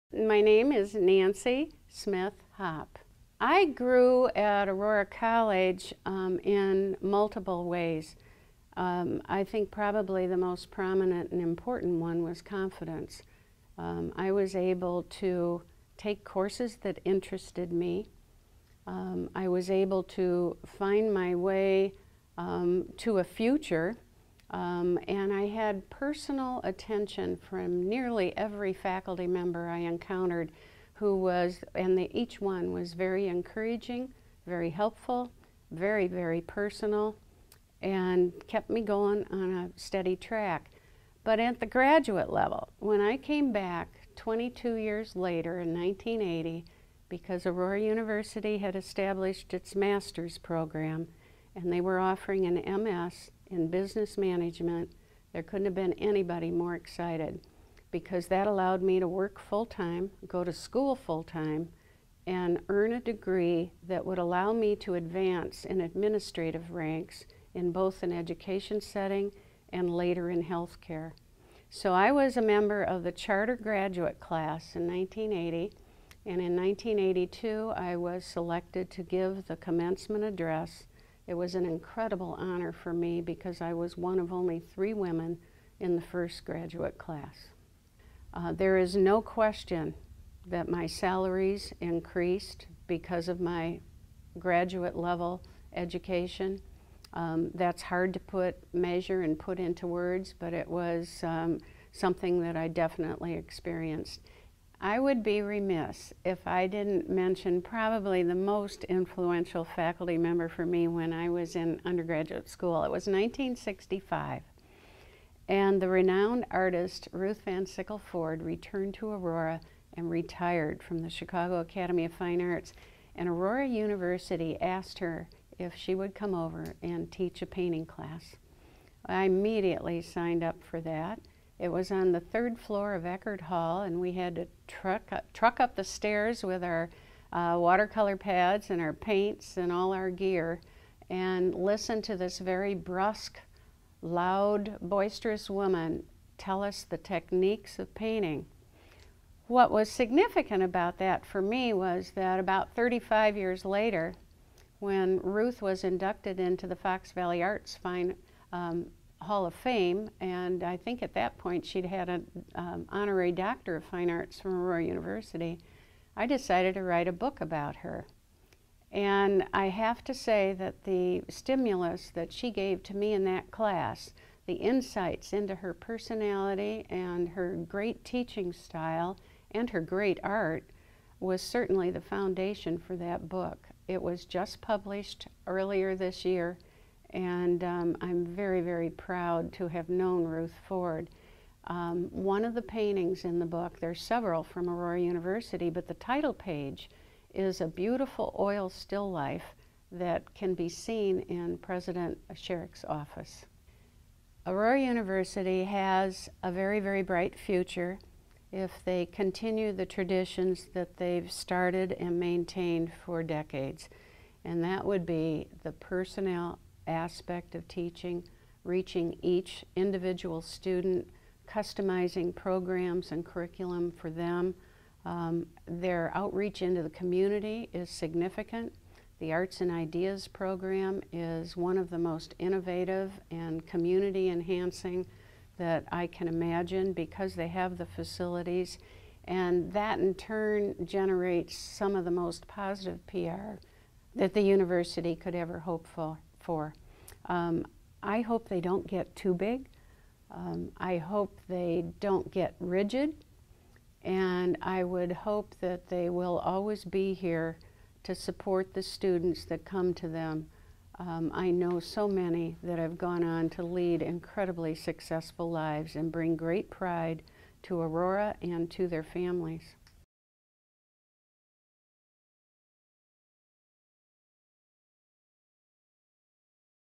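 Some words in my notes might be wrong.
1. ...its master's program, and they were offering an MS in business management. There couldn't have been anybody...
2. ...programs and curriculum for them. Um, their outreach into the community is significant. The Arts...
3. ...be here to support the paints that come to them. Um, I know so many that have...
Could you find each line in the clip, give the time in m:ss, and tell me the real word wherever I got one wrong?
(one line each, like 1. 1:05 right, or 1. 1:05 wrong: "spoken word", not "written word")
1. 0:49 right
2. 3:42 right
3. 4:16 wrong: "students", not "paints".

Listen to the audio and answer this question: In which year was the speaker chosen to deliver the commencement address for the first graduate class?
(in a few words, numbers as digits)
1982.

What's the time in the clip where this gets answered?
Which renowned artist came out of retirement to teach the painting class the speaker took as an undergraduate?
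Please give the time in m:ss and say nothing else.
1:57.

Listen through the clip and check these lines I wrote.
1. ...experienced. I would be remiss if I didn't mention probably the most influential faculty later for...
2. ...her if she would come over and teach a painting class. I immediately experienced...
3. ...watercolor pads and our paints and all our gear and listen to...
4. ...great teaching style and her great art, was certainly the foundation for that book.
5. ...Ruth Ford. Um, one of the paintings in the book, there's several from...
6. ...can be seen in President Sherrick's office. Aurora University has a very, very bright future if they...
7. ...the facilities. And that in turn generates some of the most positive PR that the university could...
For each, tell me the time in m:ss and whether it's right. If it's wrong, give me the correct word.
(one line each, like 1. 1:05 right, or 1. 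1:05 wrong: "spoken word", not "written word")
1. 1:43 wrong: "member", not "later"
2. 2:04 wrong: "signed", not "experienced"
3. 2:17 right
4. 2:57 right
5. 3:10 right
6. 3:20 right
7. 3:57 right.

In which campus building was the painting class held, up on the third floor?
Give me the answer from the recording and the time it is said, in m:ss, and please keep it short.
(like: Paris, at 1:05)
Eckhart Hall, at 2:13.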